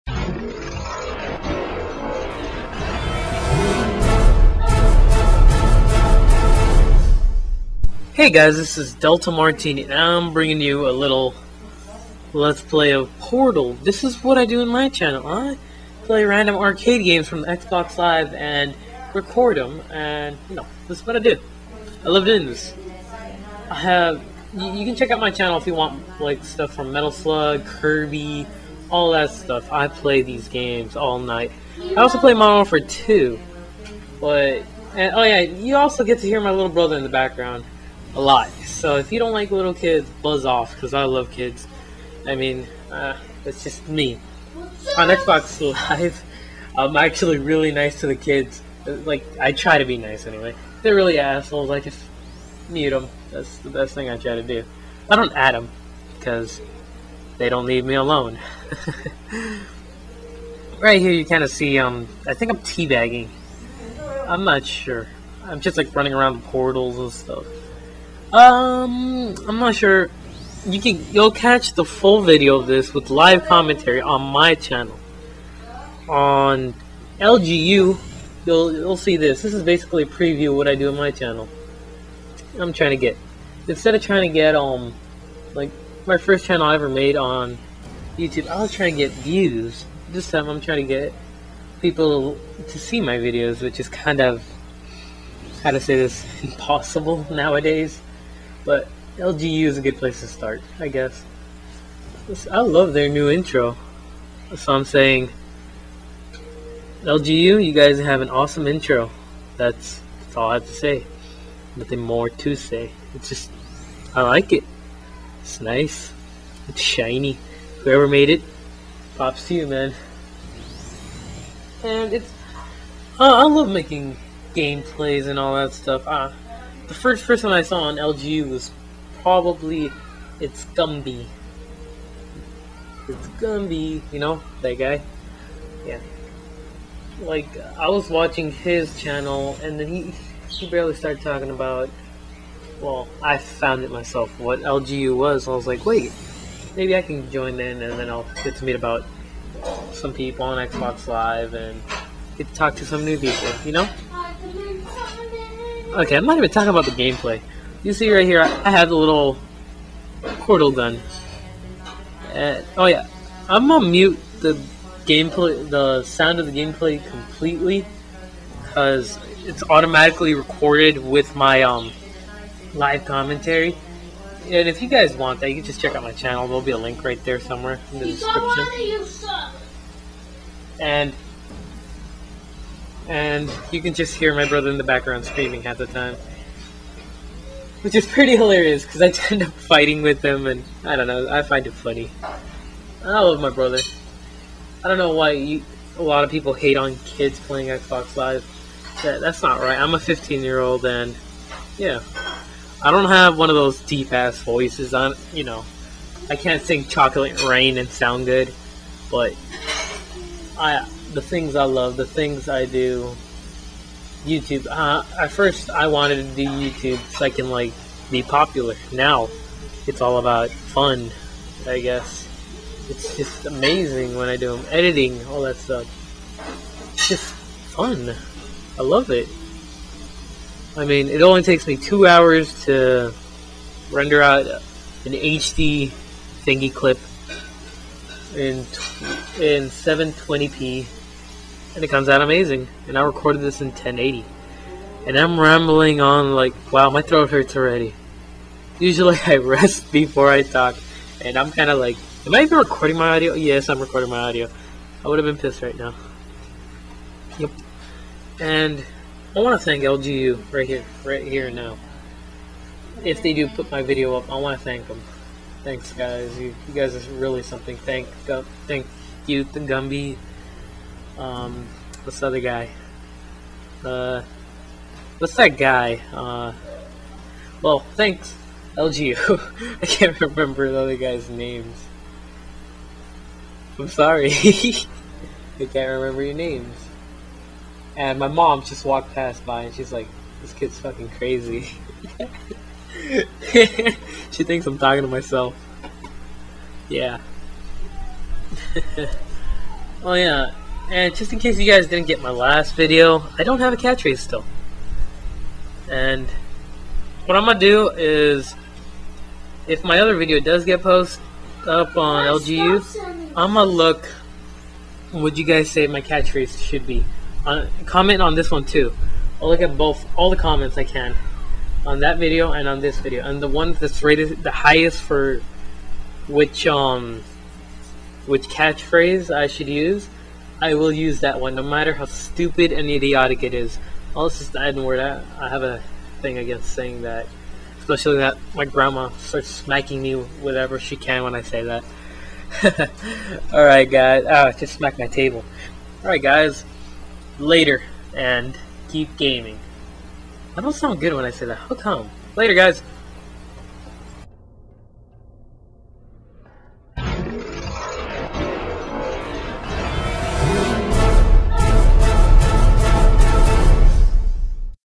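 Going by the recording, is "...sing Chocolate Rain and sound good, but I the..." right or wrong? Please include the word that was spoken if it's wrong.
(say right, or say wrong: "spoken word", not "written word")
right.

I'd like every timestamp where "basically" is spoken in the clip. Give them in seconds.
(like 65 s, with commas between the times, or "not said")
79 s.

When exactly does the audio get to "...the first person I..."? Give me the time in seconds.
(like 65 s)
126 s.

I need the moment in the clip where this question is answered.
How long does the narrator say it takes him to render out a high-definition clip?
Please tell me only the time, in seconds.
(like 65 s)
231 s.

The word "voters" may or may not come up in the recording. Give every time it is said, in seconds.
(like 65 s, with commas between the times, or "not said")
not said.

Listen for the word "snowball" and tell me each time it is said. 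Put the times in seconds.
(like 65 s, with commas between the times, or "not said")
not said.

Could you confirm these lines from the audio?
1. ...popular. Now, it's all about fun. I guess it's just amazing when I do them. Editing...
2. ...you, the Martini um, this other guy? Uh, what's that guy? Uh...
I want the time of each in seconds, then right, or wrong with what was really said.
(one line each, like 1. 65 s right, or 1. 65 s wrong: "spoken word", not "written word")
1. 218 s right
2. 269 s wrong: "Gumby", not "Martini".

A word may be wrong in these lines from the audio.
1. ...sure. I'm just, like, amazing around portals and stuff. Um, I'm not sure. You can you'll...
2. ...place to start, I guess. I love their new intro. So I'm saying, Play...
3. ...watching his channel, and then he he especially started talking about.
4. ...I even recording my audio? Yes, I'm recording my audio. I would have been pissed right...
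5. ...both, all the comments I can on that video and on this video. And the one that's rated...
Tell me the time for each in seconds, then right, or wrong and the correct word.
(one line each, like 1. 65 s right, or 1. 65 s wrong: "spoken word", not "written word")
1. 64 s wrong: "running", not "amazing"
2. 99 s wrong: "LGU", not "Play"
3. 138 s wrong: "barely", not "especially"
4. 252 s right
5. 319 s right.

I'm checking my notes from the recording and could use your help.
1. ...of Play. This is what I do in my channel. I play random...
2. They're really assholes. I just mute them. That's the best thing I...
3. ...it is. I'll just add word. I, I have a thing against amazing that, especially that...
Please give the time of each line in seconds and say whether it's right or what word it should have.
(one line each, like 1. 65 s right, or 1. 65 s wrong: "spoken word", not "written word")
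1. 12 s wrong: "Portal", not "Play"
2. 50 s right
3. 333 s wrong: "saying", not "amazing".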